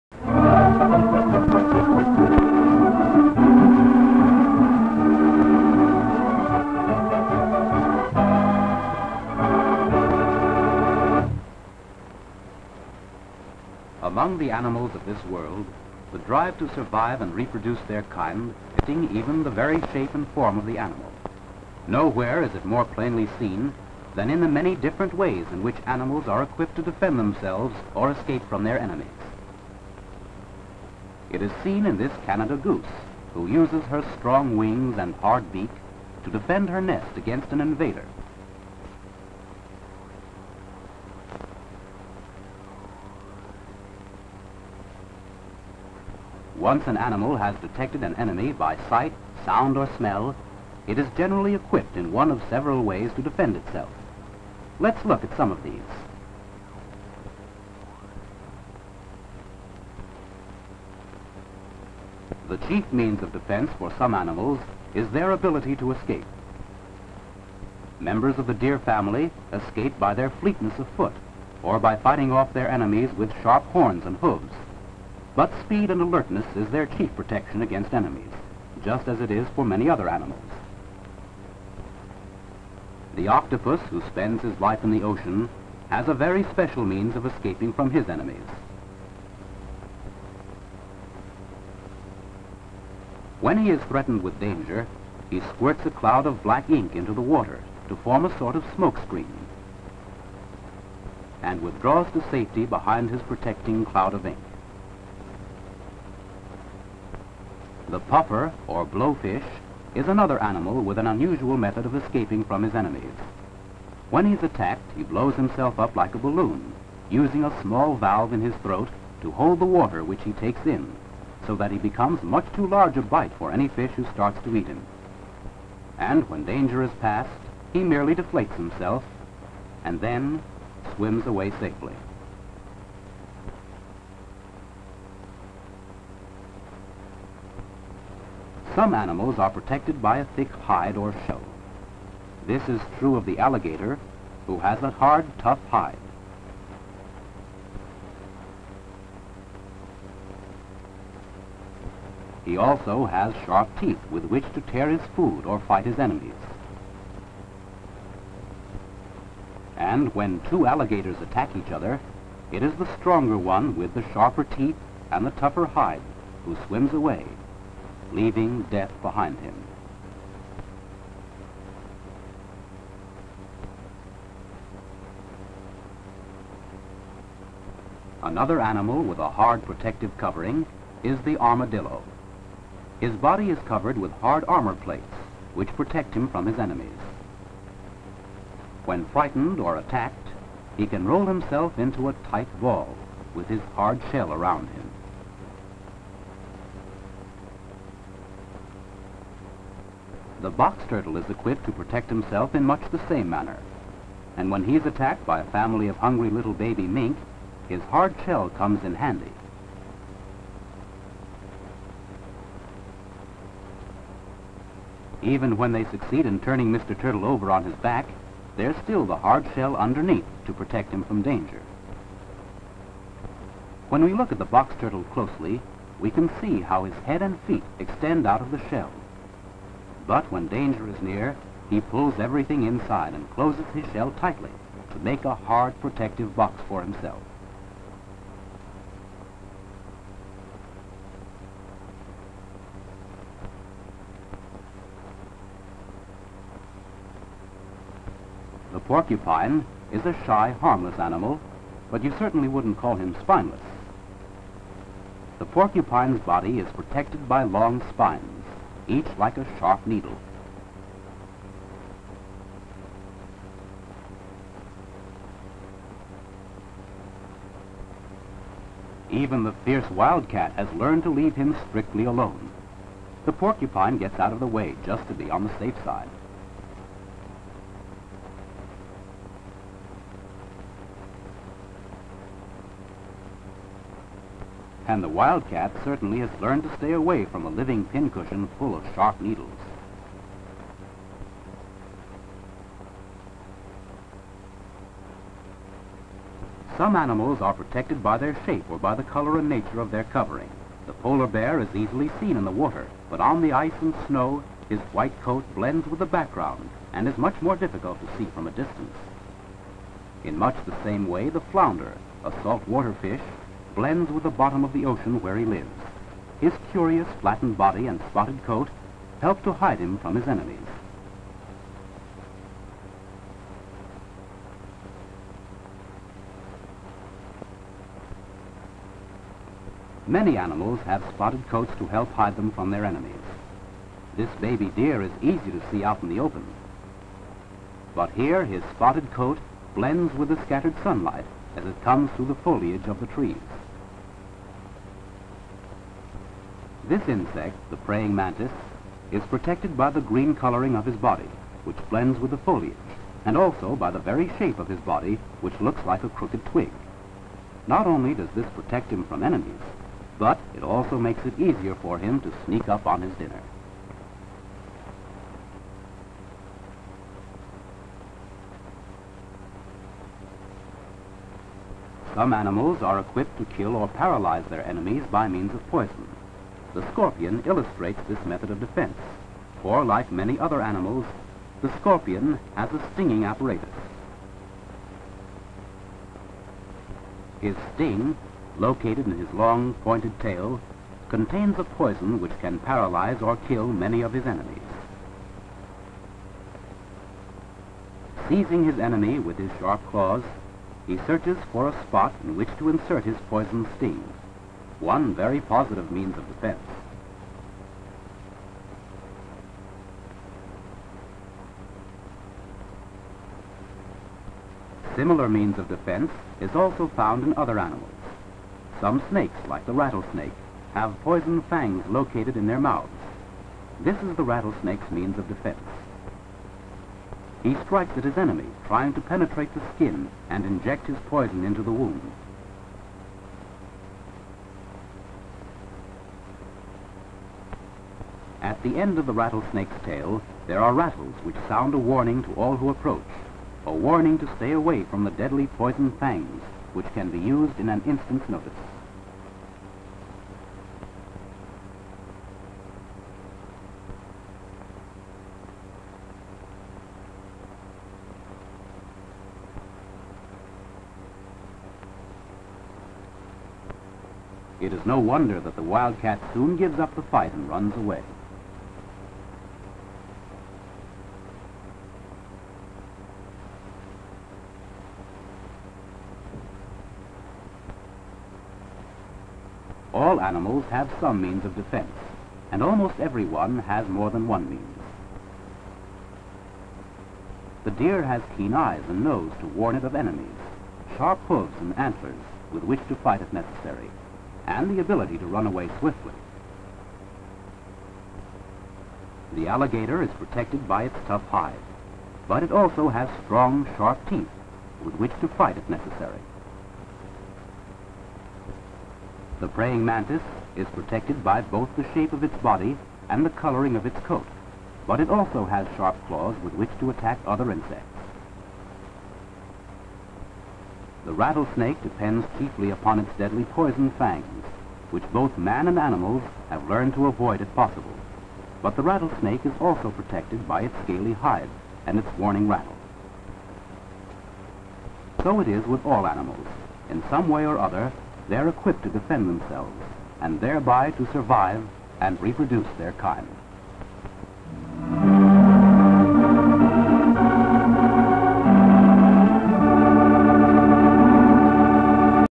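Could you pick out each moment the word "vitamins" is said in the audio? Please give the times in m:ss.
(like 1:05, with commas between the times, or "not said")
not said.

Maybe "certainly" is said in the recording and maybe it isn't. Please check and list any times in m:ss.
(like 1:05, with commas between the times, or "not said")
4:12, 4:45.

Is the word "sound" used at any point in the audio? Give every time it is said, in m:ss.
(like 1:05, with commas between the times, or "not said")
0:49, 7:21.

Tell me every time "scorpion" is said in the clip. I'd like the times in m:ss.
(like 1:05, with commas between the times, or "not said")
6:16, 6:21.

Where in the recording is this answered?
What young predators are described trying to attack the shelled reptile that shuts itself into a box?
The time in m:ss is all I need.
3:26.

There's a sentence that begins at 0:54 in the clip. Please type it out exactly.
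Let's look at some of these.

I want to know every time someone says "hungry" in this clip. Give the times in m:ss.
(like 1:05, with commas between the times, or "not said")
3:25.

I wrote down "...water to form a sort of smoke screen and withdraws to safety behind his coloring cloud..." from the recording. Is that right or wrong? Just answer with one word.
wrong.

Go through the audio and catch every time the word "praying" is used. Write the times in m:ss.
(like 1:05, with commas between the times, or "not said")
5:47, 8:29.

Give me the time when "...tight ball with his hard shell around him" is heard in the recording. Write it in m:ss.
3:12.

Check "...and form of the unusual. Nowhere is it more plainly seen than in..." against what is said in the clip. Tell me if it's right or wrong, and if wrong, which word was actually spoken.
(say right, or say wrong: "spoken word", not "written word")
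wrong: "animal", not "unusual".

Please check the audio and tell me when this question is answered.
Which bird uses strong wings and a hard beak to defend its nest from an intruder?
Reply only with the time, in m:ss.
0:32.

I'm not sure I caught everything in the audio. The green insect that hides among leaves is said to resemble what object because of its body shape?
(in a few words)
A crooked twig.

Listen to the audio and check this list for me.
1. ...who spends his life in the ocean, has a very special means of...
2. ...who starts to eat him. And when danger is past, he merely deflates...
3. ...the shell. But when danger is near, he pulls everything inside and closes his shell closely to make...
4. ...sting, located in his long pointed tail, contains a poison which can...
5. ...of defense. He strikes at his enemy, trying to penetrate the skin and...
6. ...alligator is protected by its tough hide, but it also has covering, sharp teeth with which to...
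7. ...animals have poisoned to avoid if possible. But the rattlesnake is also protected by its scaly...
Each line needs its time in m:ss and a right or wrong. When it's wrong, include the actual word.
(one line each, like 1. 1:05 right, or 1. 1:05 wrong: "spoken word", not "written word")
1. 1:23 right
2. 2:03 right
3. 3:48 wrong: "tightly", not "closely"
4. 6:27 right
5. 7:05 right
6. 8:19 wrong: "strong", not "covering"
7. 8:45 wrong: "learned", not "poisoned".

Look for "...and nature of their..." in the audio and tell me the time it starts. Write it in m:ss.
4:59.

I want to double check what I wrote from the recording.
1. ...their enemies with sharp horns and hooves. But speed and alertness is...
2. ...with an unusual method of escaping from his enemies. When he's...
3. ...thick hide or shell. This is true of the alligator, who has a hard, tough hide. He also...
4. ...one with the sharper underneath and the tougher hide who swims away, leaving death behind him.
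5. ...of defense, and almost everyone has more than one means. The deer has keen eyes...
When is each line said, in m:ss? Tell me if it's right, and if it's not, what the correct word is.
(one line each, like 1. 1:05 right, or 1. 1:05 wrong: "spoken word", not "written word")
1. 1:12 right
2. 1:50 right
3. 2:20 right
4. 2:43 wrong: "teeth", not "underneath"
5. 8:01 right.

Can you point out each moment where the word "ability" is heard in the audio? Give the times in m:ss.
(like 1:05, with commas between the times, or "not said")
1:05, 8:14.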